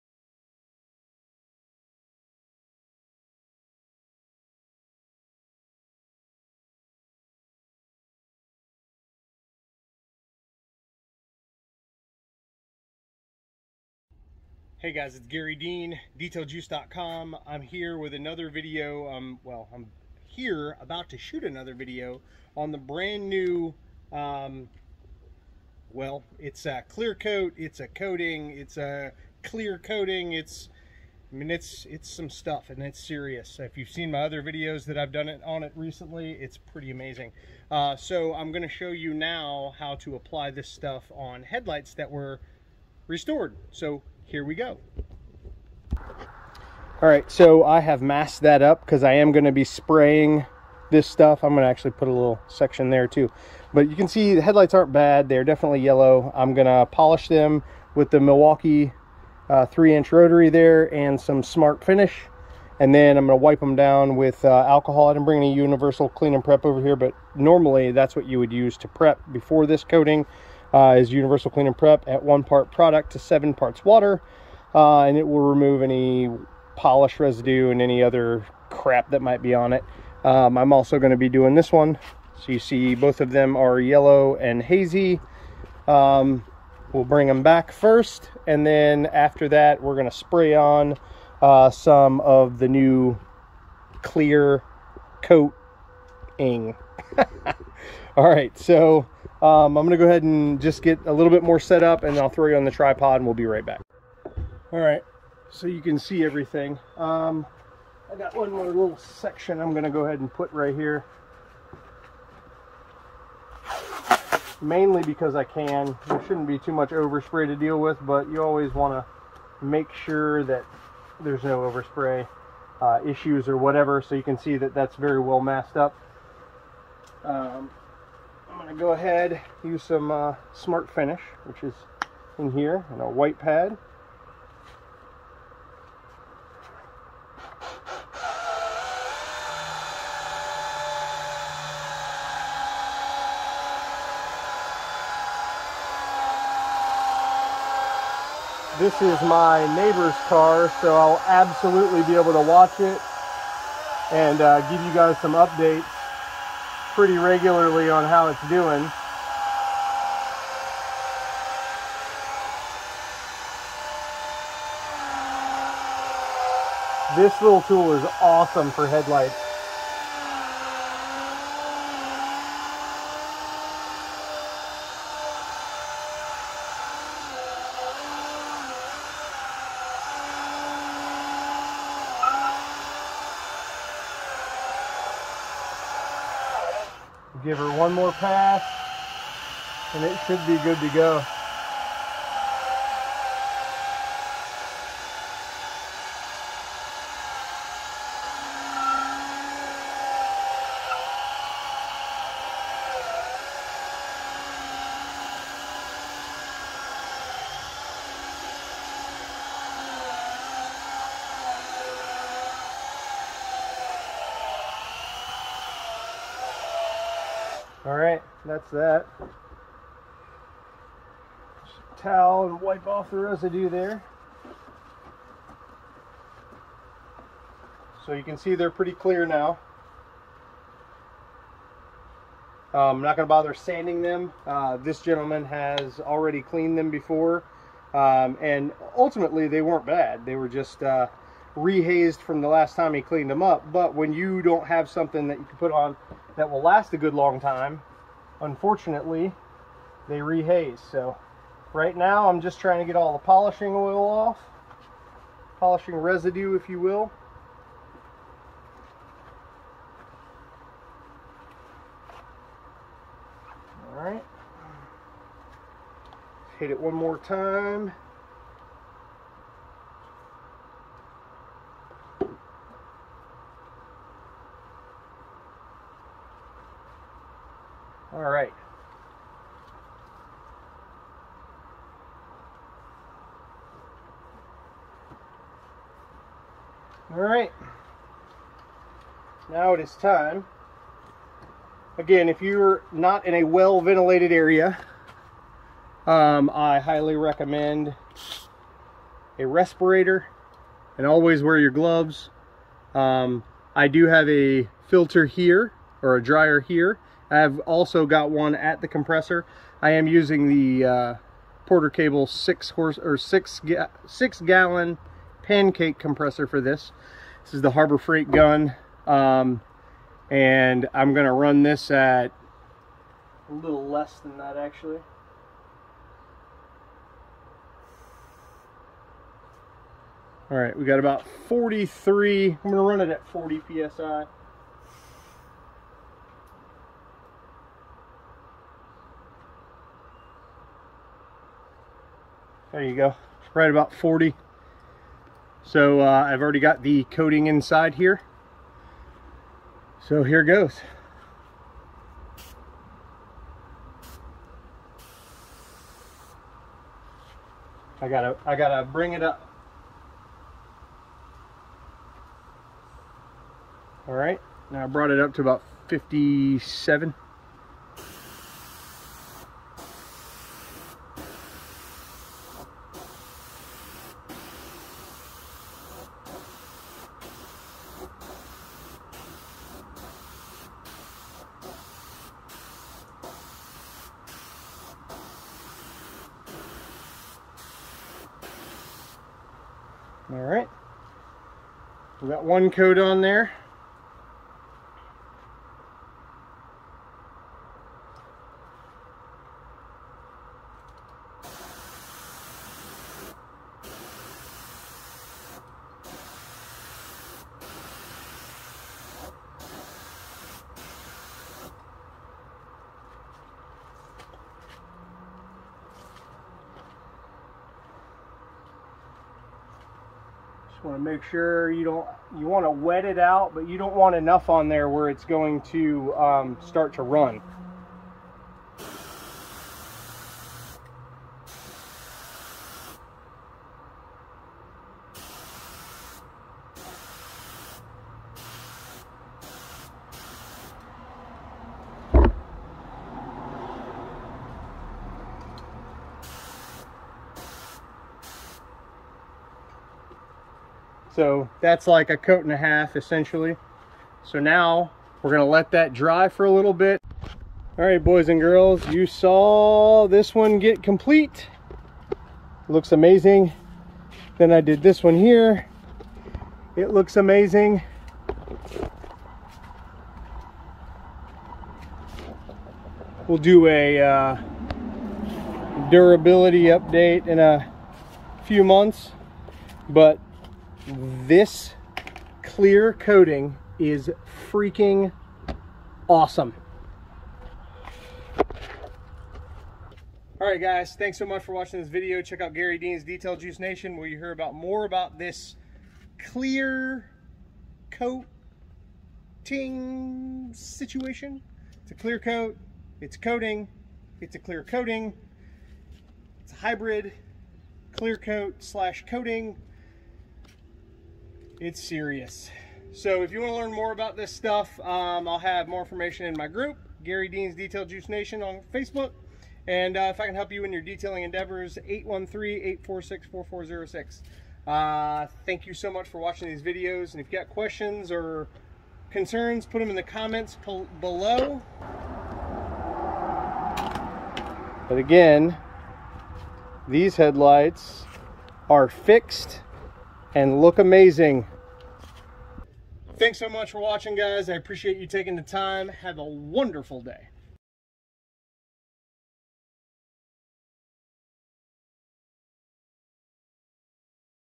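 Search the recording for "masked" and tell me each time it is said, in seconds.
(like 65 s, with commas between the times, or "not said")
48 s, 125 s.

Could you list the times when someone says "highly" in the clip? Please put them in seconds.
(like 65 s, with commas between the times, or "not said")
296 s.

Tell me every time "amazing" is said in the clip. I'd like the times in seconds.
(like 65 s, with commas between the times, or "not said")
36 s, 462 s, 467 s, 540 s.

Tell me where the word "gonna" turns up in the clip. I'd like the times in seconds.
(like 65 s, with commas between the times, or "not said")
38 s, 99 s, 109 s, 321 s, 332 s, 455 s.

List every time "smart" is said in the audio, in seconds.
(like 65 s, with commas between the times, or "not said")
61 s, 130 s.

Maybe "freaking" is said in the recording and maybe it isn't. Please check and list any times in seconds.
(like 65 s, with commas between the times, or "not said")
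484 s.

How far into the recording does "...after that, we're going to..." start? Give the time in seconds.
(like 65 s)
89 s.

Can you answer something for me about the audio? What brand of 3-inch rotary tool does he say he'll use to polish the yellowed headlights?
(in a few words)
Milwaukee.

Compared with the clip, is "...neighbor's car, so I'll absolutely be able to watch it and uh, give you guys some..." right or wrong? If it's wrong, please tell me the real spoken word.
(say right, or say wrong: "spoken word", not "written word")
right.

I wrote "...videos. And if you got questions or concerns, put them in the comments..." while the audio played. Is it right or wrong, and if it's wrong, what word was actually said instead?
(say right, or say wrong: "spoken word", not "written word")
right.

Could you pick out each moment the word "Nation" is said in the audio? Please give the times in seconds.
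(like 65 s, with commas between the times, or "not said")
493 s, 518 s.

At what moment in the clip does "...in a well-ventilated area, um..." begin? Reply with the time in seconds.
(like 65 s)
293 s.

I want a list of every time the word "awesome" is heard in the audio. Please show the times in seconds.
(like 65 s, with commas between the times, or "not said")
168 s, 486 s.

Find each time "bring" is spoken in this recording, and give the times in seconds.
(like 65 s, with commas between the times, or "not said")
65 s, 87 s, 358 s.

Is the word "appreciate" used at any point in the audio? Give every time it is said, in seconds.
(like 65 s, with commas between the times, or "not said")
544 s.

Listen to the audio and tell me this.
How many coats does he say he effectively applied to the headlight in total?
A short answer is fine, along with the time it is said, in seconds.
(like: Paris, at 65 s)
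A coat and a half, at 452 s.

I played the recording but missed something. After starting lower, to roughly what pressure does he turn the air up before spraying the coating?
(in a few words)
57.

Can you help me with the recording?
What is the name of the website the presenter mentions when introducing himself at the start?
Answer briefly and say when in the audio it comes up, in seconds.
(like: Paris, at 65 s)
DetailJuice.com, at 16 s.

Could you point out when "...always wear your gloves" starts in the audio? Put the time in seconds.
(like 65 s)
301 s.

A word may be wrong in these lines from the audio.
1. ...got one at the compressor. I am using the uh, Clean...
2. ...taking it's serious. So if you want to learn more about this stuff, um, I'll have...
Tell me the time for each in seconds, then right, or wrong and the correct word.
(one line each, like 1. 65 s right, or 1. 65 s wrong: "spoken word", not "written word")
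1. 308 s wrong: "Porter", not "Clean"
2. 509 s wrong: "coating", not "taking".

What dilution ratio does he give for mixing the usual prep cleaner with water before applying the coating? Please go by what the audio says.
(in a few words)
1 part to 7 parts water.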